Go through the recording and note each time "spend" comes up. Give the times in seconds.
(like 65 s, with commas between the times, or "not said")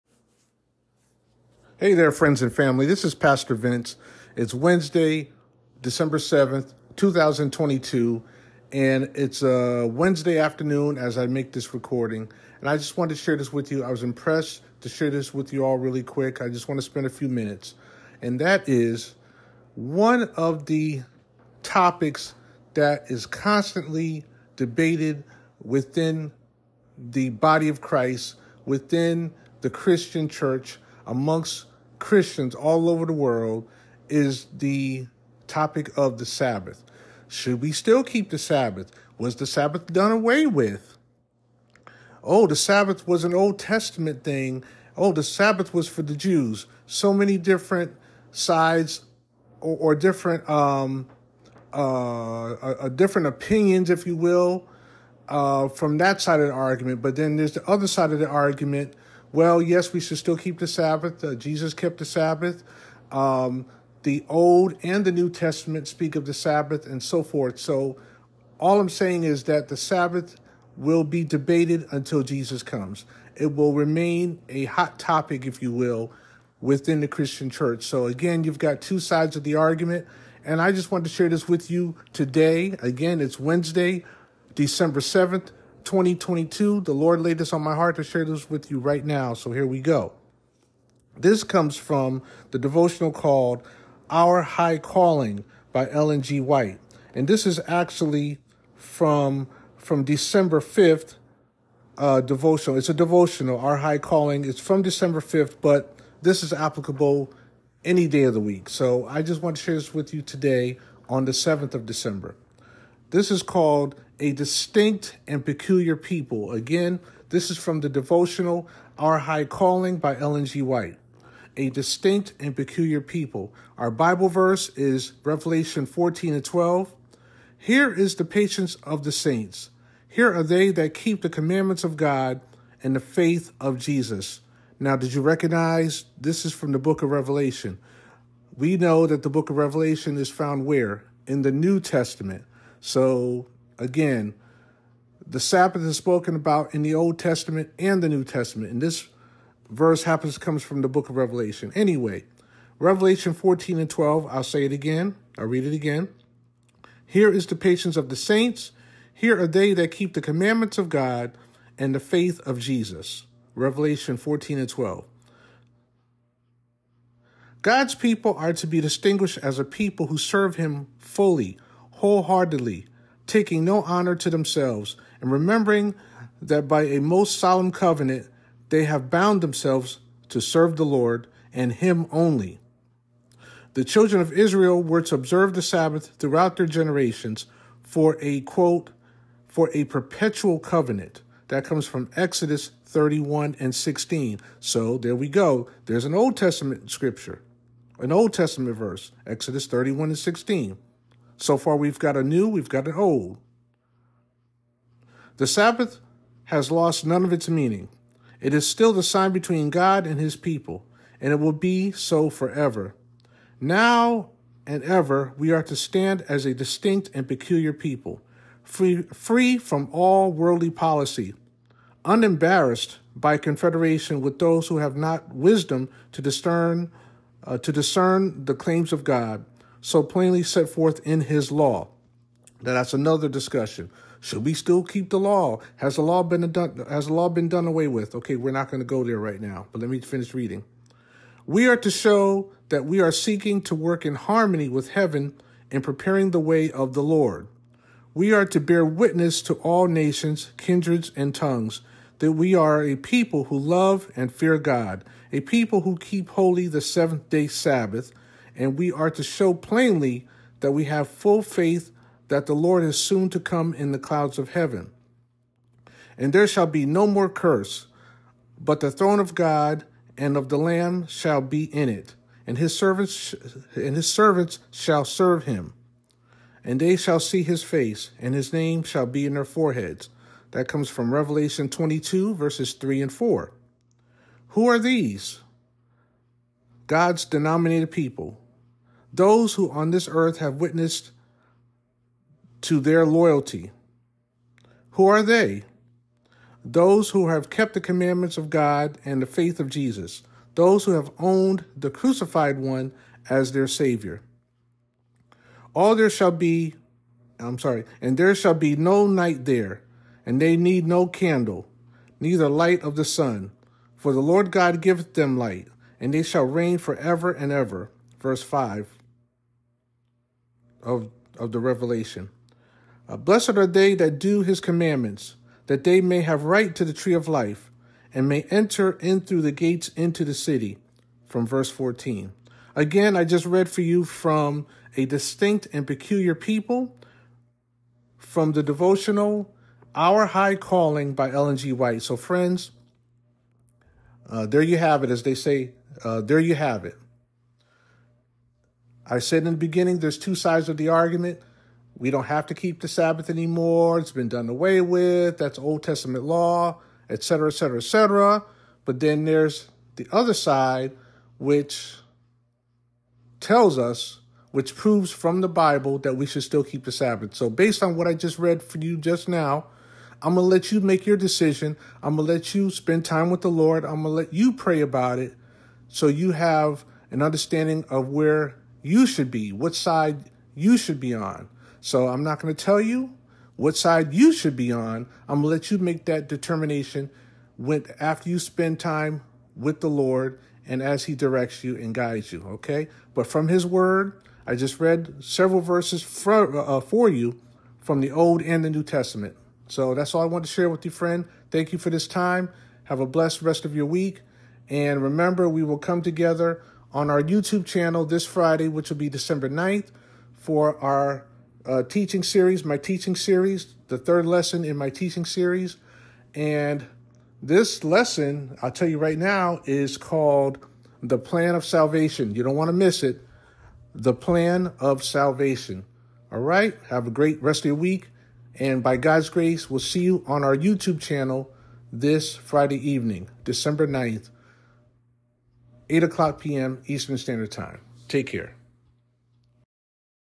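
16 s, 372 s, 388 s.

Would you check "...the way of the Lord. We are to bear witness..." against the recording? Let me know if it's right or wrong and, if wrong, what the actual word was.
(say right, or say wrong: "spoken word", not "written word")
right.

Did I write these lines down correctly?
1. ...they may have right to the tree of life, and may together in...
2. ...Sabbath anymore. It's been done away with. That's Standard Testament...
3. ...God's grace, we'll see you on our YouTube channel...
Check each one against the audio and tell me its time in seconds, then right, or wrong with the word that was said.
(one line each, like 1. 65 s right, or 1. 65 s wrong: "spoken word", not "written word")
1. 325 s wrong: "enter", not "together"
2. 352 s wrong: "Old", not "Standard"
3. 428 s right.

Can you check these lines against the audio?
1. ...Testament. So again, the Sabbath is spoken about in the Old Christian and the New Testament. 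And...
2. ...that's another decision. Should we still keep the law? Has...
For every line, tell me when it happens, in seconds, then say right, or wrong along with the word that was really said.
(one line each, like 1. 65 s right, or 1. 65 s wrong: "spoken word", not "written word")
1. 141 s wrong: "Testament", not "Christian"
2. 232 s wrong: "discussion", not "decision".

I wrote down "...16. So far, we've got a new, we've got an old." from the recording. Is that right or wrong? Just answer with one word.
right.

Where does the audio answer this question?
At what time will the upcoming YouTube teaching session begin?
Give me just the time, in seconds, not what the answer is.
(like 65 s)
435 s.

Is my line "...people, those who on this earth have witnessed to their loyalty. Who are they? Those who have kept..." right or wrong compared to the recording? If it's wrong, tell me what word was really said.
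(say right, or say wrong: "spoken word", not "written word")
right.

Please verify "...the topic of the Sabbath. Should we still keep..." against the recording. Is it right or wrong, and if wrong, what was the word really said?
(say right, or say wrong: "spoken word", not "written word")
right.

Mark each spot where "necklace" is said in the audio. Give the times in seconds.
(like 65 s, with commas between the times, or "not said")
not said.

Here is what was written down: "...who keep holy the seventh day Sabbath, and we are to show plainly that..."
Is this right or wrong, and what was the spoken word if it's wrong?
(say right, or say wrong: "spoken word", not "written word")
right.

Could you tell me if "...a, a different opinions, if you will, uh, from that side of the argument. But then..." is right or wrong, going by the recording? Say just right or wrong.
right.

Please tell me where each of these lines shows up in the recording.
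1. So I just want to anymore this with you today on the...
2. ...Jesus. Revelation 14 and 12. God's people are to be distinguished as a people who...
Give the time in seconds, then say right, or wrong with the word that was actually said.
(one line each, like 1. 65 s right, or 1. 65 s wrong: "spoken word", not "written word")
1. 108 s wrong: "share", not "anymore"
2. 162 s right.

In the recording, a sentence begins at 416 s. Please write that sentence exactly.
And this lesson, I'll tell you right now, is called The Plan of Salvation.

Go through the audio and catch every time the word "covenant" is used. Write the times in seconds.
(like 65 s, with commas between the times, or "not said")
177 s, 190 s.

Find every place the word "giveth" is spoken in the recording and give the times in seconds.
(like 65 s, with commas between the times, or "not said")
314 s.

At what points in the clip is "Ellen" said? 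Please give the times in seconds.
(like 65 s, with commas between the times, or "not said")
95 s, 120 s, 341 s.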